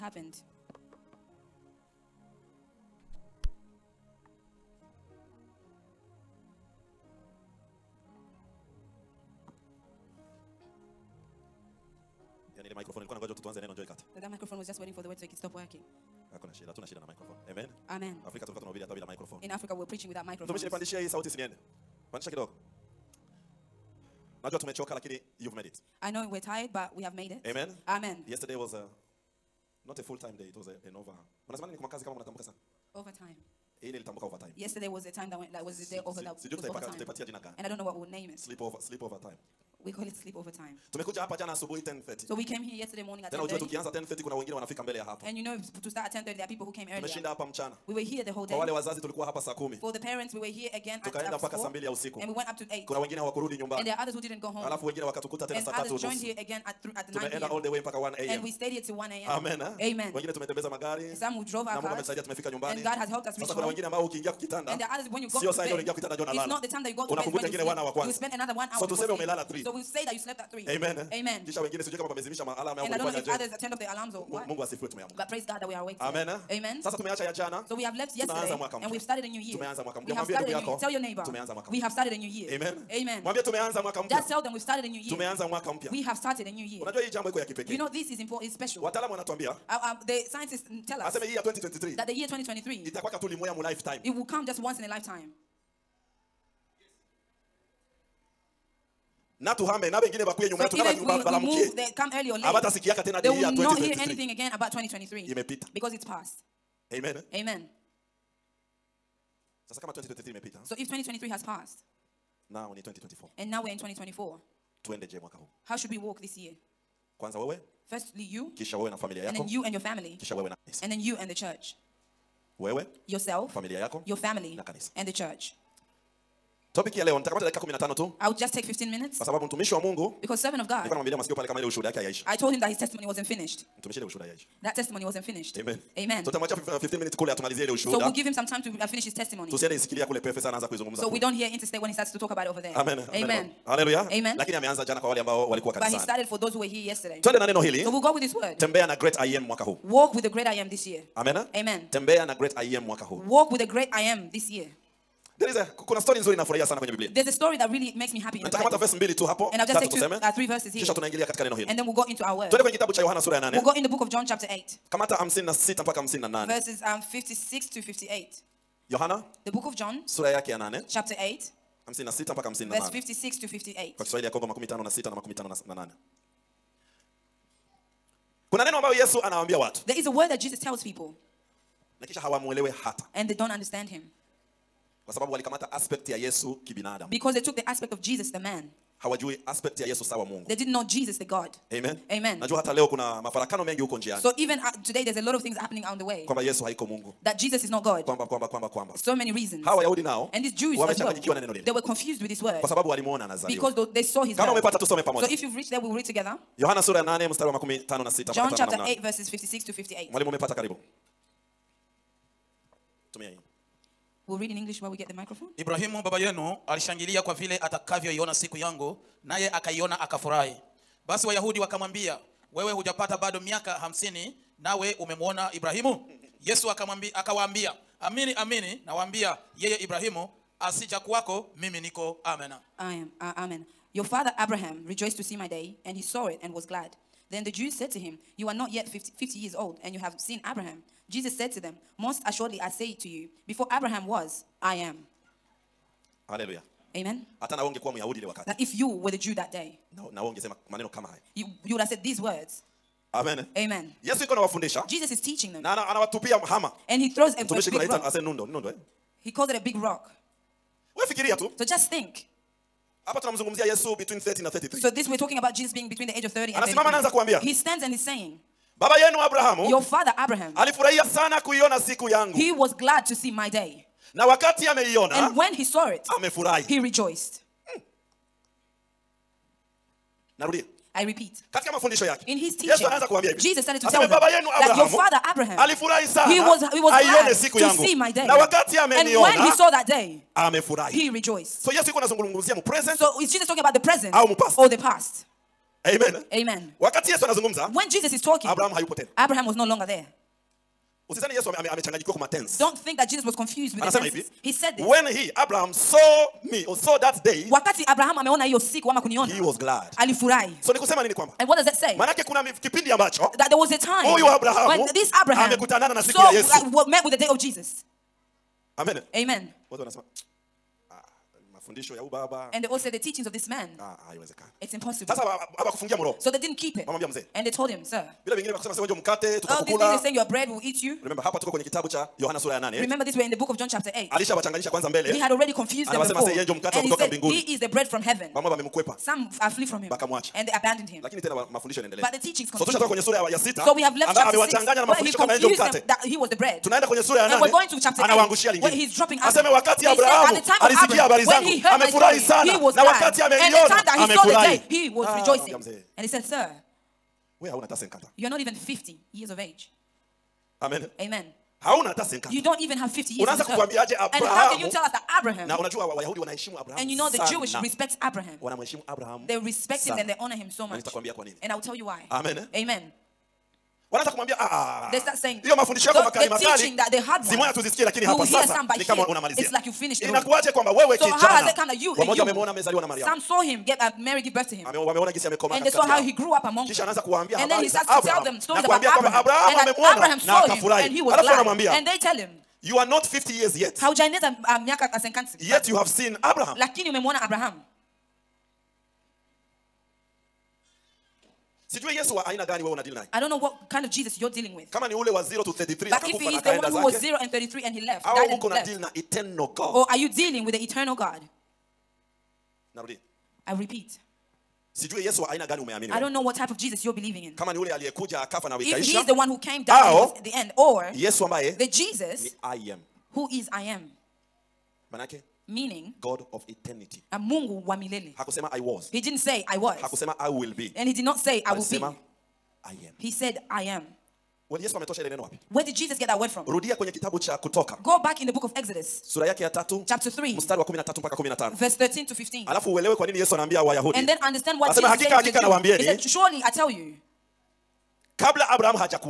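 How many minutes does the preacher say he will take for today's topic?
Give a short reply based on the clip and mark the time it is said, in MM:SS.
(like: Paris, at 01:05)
15 minutes, at 02:08.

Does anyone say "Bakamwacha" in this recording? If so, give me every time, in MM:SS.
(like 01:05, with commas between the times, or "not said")
05:39.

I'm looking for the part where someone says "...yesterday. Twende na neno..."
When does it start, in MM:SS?
02:26.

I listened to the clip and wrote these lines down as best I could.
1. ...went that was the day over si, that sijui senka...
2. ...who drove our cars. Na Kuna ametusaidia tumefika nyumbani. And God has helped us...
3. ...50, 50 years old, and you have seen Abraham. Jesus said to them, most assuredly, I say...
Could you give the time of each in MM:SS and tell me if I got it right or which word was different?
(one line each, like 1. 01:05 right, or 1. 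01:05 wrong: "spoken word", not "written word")
1. 00:35 wrong: "tutaipaka", not "senka"
2. 01:01 wrong: "Mungu", not "Kuna"
3. 03:58 right.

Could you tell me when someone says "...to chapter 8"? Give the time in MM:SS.
05:47.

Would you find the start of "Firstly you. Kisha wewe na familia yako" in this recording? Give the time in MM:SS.
01:57.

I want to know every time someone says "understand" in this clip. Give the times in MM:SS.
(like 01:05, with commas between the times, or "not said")
03:03, 07:24.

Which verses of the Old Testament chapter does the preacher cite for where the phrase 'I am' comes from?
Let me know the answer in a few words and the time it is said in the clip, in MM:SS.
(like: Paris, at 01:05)
13 to 15, at 07:21.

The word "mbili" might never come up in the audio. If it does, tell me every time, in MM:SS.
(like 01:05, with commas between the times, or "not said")
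00:51, 02:38.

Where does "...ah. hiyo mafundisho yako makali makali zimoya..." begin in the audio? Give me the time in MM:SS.
06:15.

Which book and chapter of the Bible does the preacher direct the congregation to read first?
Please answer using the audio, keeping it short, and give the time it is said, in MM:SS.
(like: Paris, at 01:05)
John chapter 8, at 02:43.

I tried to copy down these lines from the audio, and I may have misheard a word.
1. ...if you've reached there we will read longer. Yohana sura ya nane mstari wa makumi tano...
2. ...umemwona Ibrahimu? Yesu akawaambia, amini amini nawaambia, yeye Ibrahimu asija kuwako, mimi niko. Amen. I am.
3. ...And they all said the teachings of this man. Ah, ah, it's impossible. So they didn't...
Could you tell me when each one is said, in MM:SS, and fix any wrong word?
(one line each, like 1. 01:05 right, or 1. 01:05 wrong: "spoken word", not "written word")
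1. 03:25 wrong: "together", not "longer"
2. 03:44 right
3. 05:21 right.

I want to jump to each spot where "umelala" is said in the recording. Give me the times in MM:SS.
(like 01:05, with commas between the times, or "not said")
01:09.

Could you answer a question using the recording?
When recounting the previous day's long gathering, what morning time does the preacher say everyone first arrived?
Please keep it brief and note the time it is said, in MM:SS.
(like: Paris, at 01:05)
10:30, at 00:42.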